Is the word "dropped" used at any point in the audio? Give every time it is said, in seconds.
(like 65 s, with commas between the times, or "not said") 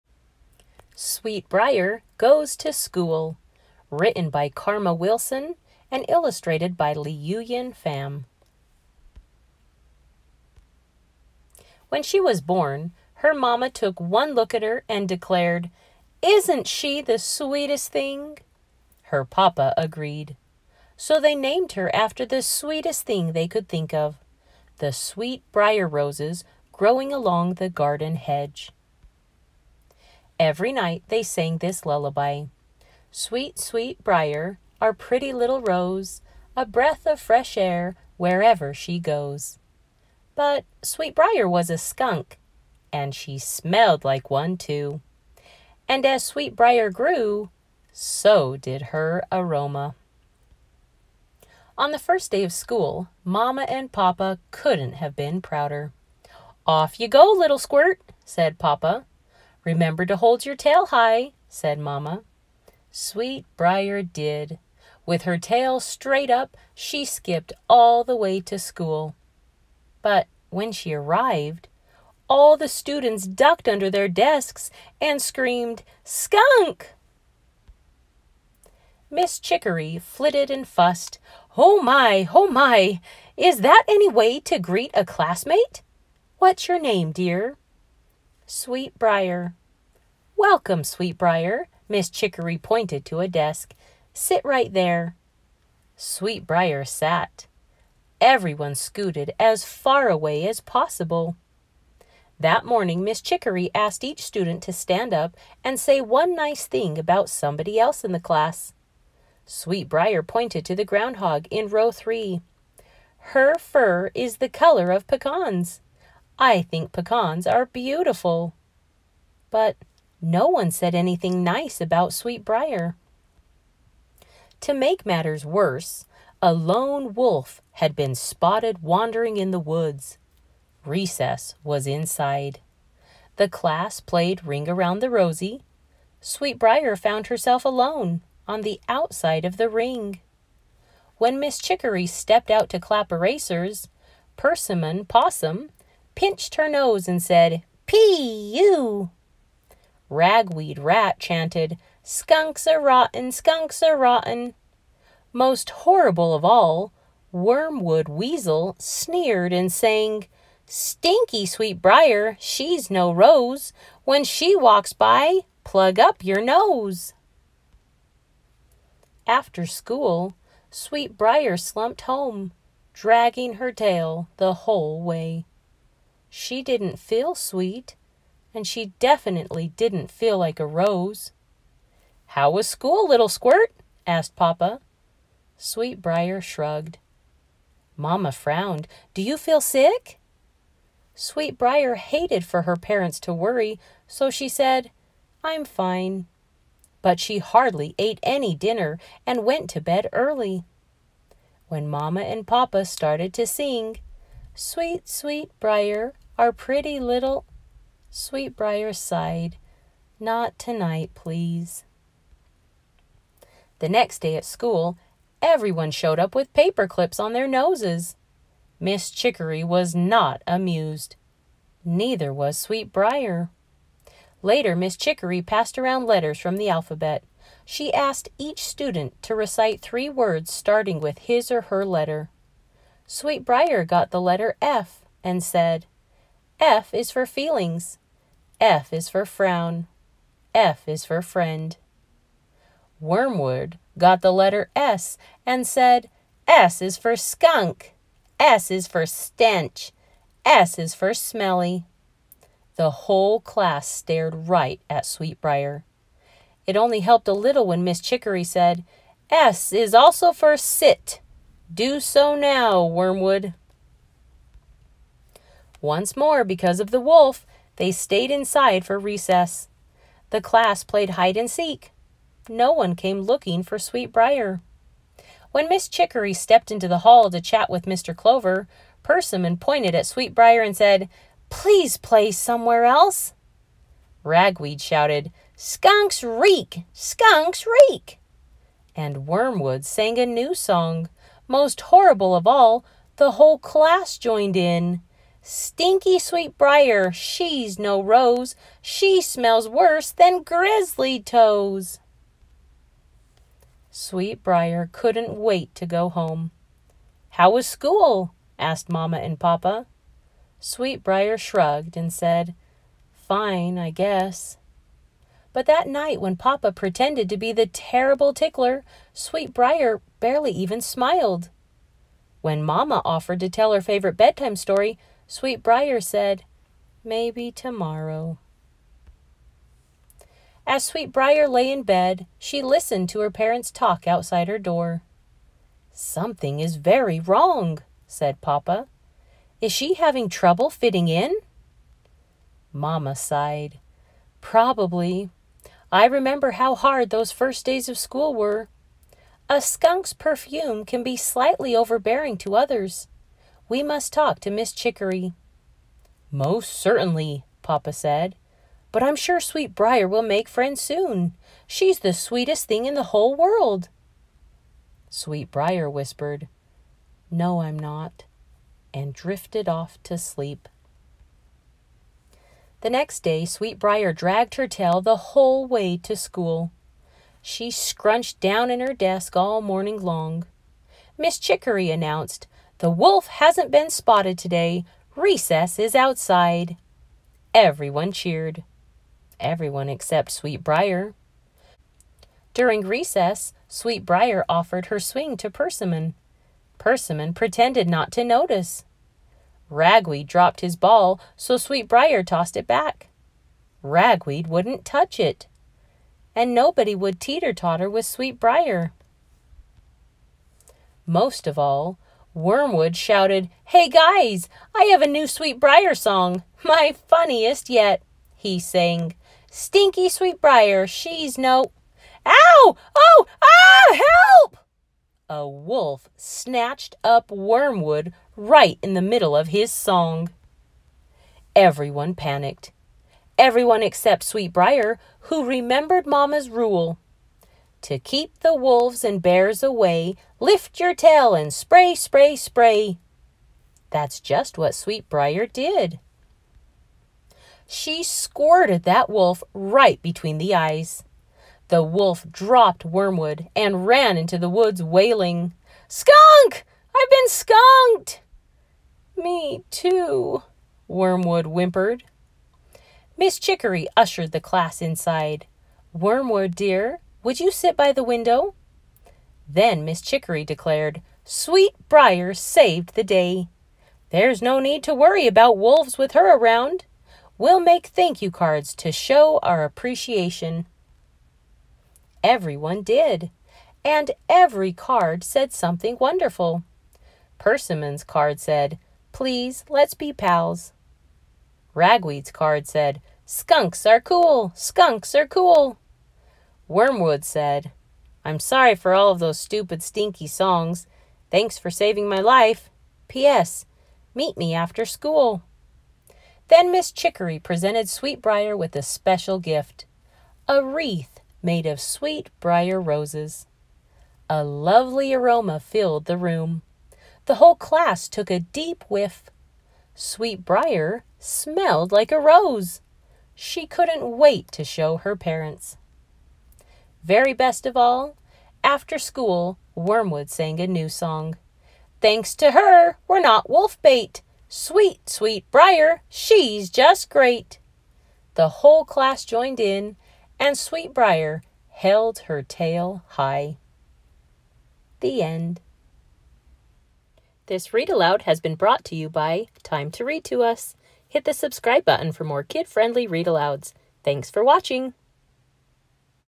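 400 s, 452 s.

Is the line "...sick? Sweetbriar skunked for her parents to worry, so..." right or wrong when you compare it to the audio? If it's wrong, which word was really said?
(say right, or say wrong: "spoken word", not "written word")
wrong: "hated", not "skunked".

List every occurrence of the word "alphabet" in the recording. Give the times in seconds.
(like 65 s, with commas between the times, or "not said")
226 s.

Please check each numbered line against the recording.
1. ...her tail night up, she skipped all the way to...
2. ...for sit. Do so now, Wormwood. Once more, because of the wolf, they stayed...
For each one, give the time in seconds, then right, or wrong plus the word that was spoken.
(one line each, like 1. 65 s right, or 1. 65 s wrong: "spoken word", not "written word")
1. 65 s wrong: "straight", not "night"
2. 260 s right.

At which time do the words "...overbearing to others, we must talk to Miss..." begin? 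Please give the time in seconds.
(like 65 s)
351 s.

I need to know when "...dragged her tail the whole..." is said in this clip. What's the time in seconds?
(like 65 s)
374 s.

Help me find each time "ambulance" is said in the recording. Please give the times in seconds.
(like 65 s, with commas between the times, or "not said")
not said.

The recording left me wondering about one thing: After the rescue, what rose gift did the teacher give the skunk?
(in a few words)
a wreath.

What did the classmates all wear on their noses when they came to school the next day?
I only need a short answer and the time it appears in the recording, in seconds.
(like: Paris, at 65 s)
paper clips, at 216 s.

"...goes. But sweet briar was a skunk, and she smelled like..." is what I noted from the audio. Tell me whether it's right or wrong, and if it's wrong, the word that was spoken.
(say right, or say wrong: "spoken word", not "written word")
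right.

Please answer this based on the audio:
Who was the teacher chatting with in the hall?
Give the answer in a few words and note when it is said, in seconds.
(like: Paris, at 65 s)
Mr. Clover, at 277 s.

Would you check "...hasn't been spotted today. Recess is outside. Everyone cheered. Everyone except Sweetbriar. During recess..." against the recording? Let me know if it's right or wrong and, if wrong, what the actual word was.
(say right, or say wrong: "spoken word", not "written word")
right.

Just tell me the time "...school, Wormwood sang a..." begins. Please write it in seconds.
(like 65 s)
528 s.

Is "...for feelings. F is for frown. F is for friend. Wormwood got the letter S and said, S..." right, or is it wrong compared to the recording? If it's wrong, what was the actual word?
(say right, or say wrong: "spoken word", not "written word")
right.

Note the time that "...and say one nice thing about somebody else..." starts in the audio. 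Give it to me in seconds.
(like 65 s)
105 s.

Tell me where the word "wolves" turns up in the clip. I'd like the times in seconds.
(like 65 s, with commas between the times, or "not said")
438 s, 475 s.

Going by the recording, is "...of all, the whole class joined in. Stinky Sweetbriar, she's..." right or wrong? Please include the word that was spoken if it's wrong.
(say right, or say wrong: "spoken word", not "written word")
right.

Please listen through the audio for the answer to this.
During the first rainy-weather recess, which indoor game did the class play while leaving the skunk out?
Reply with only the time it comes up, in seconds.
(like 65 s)
134 s.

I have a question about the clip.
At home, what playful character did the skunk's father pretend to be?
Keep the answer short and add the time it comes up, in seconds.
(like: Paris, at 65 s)
the terrible tickler, at 317 s.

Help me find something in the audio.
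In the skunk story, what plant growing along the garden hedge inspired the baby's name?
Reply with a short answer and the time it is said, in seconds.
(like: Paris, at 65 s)
sweet briar roses, at 24 s.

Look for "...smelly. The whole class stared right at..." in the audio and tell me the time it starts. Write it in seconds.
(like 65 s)
251 s.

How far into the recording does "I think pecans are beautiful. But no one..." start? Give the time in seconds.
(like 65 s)
116 s.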